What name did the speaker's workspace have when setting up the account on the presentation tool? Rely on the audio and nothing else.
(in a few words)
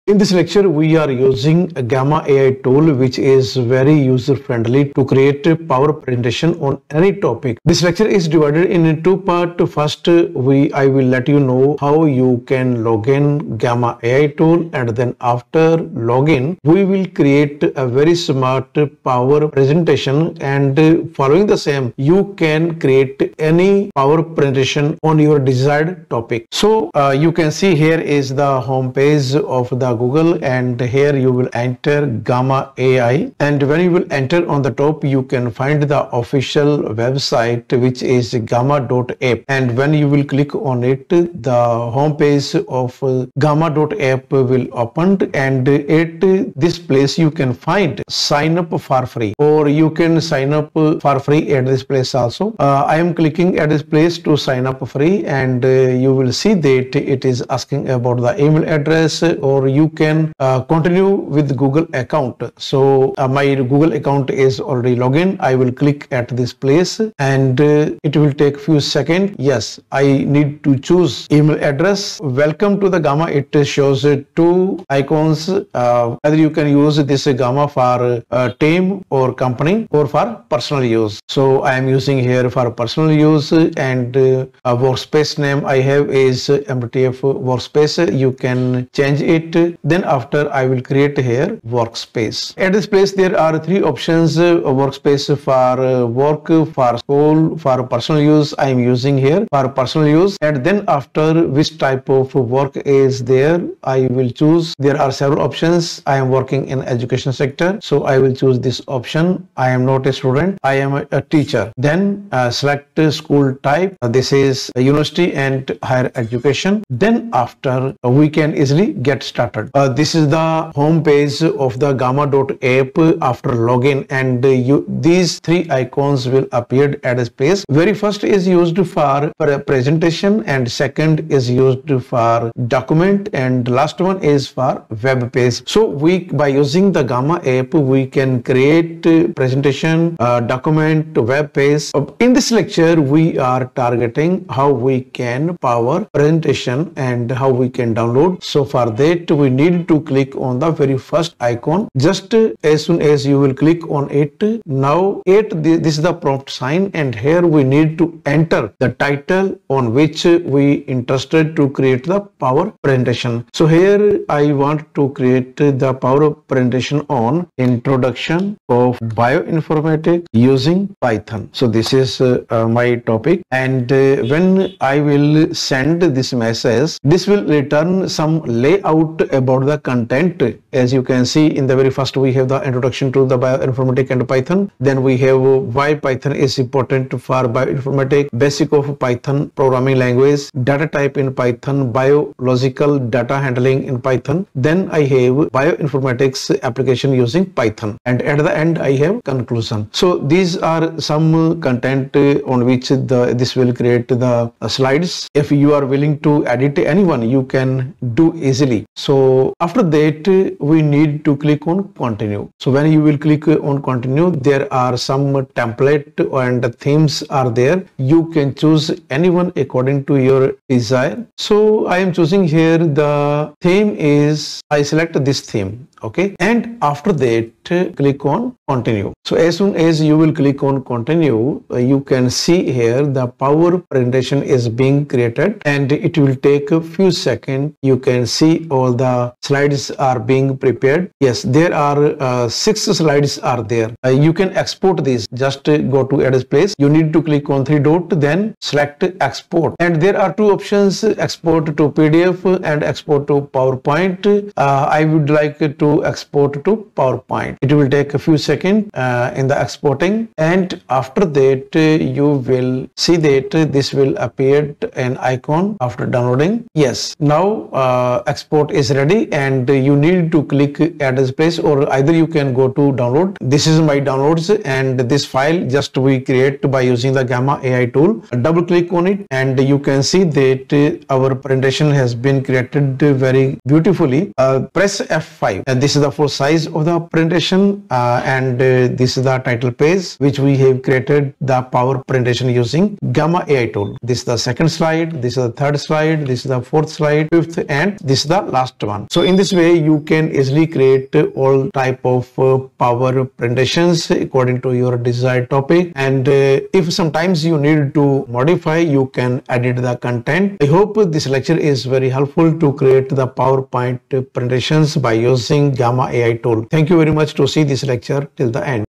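MTF workspace.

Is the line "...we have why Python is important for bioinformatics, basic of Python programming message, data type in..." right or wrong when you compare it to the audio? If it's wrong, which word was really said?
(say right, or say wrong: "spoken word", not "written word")
wrong: "language", not "message".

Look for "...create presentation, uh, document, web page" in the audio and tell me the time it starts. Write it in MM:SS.
02:18.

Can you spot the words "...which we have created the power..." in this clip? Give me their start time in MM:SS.
04:50.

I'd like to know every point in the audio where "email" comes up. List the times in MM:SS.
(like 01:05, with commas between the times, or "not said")
00:58, 01:11.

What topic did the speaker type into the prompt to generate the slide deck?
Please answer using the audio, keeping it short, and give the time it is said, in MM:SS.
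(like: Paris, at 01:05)
Introduction of bioinformatics using Python, at 02:47.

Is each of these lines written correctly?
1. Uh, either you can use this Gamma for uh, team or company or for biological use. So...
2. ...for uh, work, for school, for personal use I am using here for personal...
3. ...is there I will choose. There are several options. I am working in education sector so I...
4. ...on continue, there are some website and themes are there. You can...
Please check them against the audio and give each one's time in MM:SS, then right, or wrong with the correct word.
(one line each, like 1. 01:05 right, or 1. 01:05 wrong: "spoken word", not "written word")
1. 01:15 wrong: "personal", not "biological"
2. 01:35 right
3. 01:42 right
4. 03:33 wrong: "template", not "website".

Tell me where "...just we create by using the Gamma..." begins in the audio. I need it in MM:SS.
04:35.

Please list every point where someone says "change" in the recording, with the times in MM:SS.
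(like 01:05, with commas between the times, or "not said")
01:28.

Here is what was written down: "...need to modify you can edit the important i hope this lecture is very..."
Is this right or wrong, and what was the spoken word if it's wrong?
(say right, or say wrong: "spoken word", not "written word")
wrong: "content", not "important".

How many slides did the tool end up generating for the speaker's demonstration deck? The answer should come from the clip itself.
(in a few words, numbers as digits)
6.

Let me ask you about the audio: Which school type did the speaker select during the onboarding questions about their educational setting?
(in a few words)
University and higher education.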